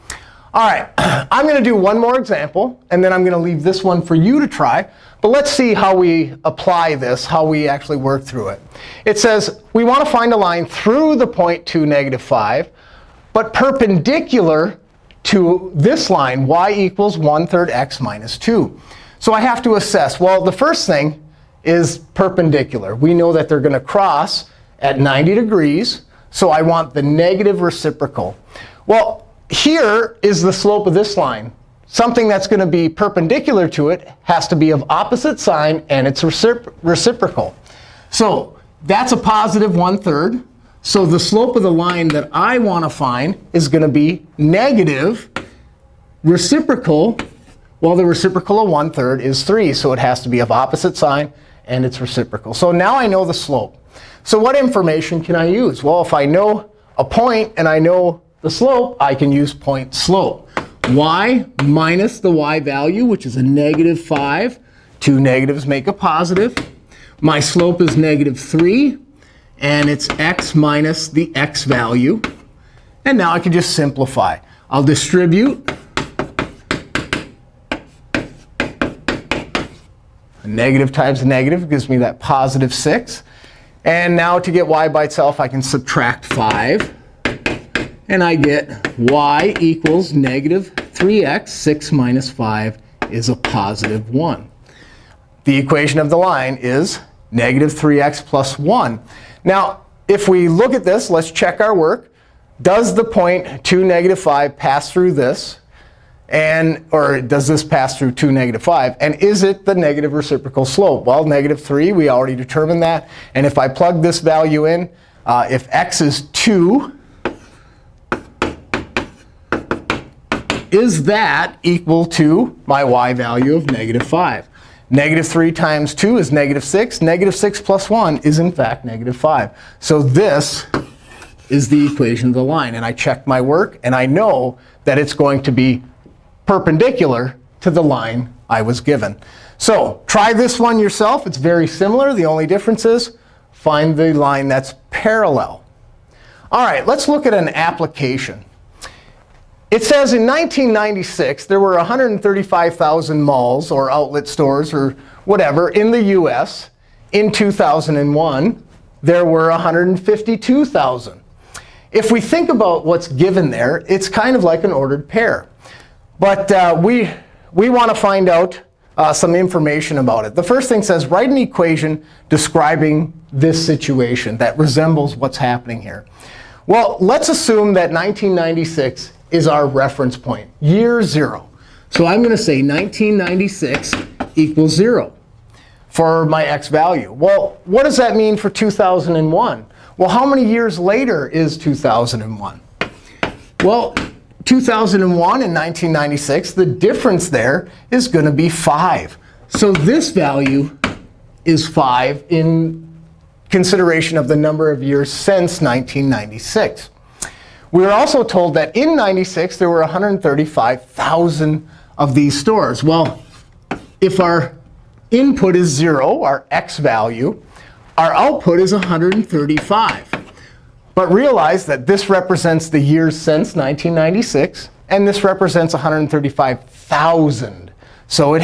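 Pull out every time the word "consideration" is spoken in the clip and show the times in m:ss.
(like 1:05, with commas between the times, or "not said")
3:23.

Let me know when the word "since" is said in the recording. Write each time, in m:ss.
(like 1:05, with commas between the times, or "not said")
3:25, 3:43.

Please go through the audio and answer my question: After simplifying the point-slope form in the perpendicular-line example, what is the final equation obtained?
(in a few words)
y = -3x + 1.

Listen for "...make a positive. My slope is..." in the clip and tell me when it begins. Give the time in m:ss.
1:05.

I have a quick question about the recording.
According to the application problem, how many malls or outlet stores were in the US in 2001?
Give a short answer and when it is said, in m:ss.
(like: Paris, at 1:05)
152,000, at 2:39.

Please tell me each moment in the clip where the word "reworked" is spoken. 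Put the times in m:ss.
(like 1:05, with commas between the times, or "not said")
not said.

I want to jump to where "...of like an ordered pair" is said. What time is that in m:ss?
2:44.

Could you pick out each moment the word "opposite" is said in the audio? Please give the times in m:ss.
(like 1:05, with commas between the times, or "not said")
0:34, 0:50.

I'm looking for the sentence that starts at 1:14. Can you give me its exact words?
I'll distribute a negative times a negative gives me that positive 6.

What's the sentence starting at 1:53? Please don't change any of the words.
And if I plug this value in, uh, if x is 2, is that equal to my y value of negative 5?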